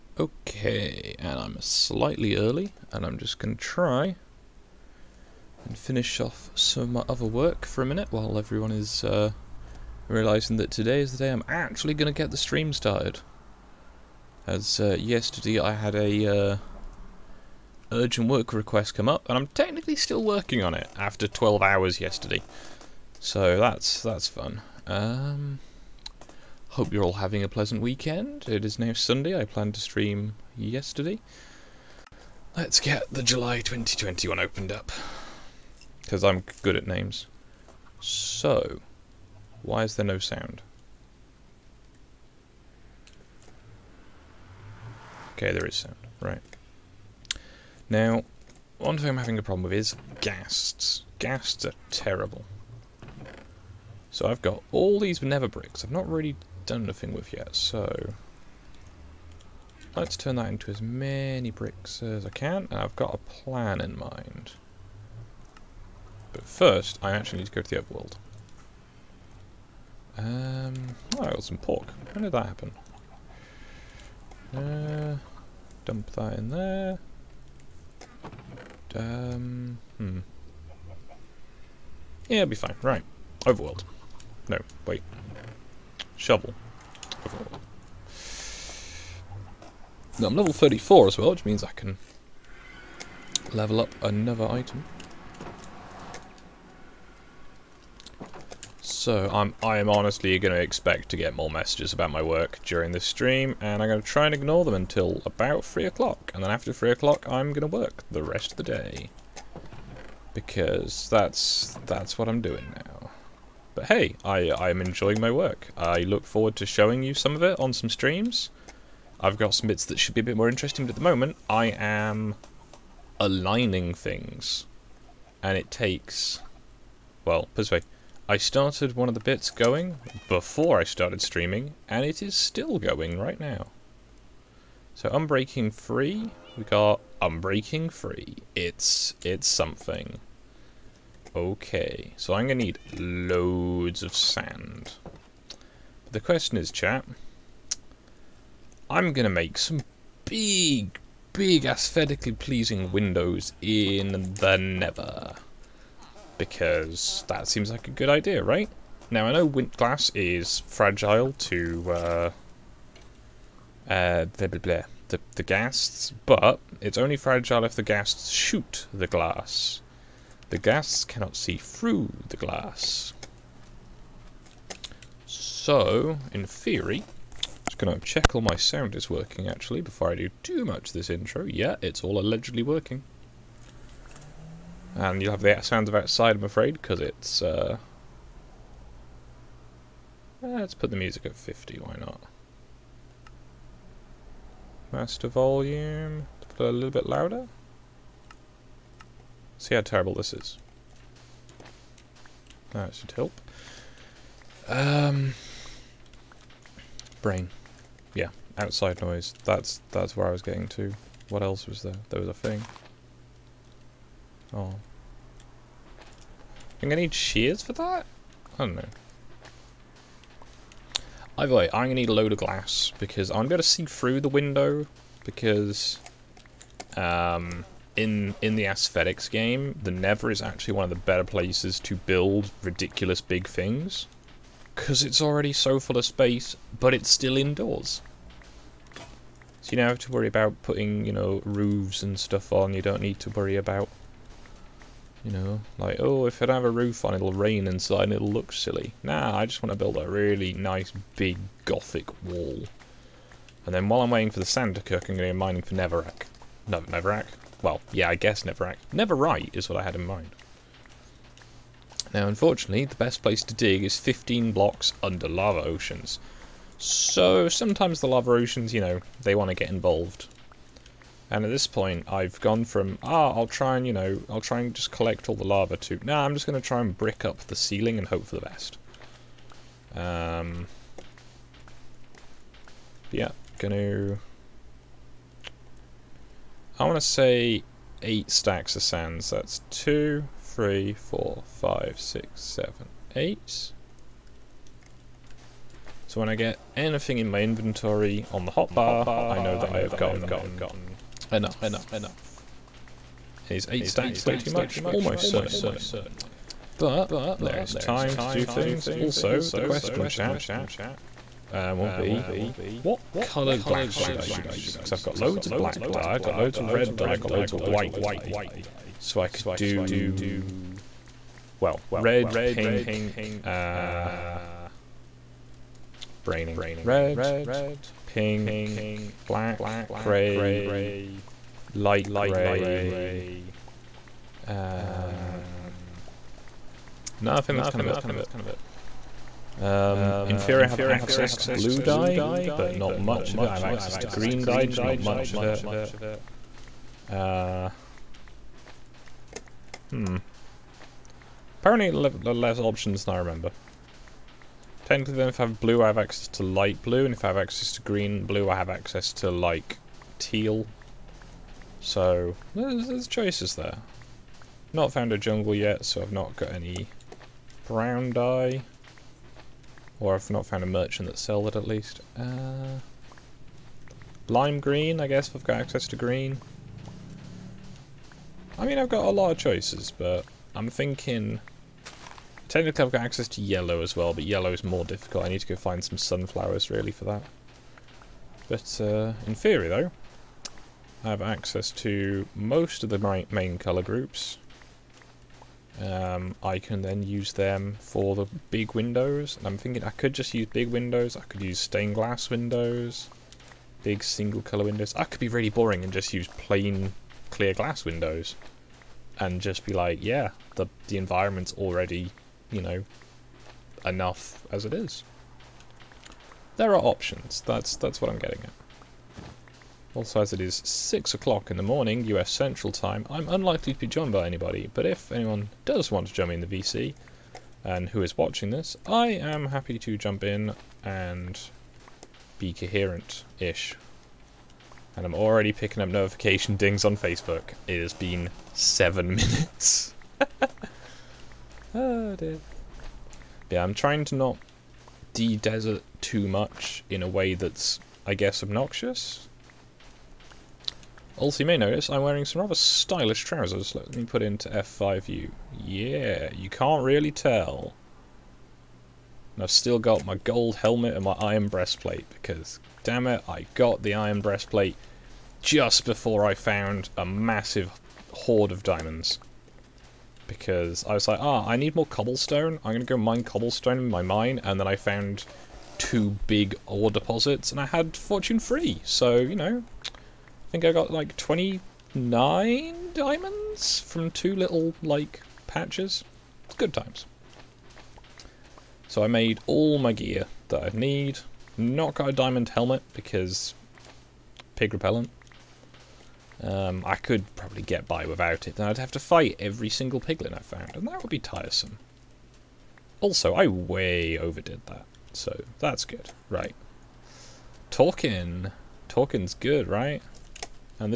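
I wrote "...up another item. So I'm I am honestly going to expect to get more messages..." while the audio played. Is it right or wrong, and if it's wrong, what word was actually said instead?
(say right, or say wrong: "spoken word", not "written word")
right.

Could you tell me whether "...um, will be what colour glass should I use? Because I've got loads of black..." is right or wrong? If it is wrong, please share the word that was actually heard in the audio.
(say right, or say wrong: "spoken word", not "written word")
right.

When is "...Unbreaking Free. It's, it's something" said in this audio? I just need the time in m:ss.
2:17.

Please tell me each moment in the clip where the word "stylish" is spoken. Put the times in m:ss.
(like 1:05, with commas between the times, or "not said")
7:32.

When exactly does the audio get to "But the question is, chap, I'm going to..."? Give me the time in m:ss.
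2:25.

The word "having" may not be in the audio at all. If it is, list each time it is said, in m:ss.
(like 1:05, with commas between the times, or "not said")
0:27, 0:49.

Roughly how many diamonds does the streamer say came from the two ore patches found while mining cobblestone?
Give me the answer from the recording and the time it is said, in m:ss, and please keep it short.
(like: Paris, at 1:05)
29, at 8:01.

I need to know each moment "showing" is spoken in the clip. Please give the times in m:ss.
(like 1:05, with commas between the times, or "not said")
1:56.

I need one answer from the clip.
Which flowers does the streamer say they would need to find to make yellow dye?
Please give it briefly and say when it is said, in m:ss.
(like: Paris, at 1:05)
Sunflowers, at 6:25.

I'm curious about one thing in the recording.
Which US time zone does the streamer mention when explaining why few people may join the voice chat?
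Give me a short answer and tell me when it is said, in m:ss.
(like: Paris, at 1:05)
US Central Time, at 7:02.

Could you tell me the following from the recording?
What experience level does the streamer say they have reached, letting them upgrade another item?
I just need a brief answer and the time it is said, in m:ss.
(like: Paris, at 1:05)
34, at 1:30.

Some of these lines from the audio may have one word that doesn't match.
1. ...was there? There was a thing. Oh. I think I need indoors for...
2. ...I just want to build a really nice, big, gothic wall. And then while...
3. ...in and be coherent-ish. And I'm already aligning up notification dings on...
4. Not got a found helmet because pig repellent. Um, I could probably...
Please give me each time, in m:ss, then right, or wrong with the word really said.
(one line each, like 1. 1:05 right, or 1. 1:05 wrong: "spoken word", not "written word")
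1. 3:31 wrong: "shears", not "indoors"
2. 4:09 right
3. 7:10 wrong: "picking", not "aligning"
4. 8:11 wrong: "diamond", not "found".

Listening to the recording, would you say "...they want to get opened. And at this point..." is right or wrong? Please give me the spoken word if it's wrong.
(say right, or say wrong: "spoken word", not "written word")
wrong: "involved", not "opened".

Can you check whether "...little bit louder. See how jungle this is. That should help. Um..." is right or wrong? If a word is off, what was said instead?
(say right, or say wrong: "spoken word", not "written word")
wrong: "terrible", not "jungle".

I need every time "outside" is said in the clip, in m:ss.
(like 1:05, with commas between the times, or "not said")
3:05, 3:28.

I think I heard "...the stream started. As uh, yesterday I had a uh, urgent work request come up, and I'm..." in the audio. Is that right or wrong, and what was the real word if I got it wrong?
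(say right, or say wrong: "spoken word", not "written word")
right.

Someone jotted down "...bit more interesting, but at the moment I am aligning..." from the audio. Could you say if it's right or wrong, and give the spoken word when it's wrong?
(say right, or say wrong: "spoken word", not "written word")
right.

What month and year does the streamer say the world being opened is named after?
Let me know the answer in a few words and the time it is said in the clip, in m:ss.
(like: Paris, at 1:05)
July 2021, at 0:33.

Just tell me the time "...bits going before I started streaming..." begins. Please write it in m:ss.
2:09.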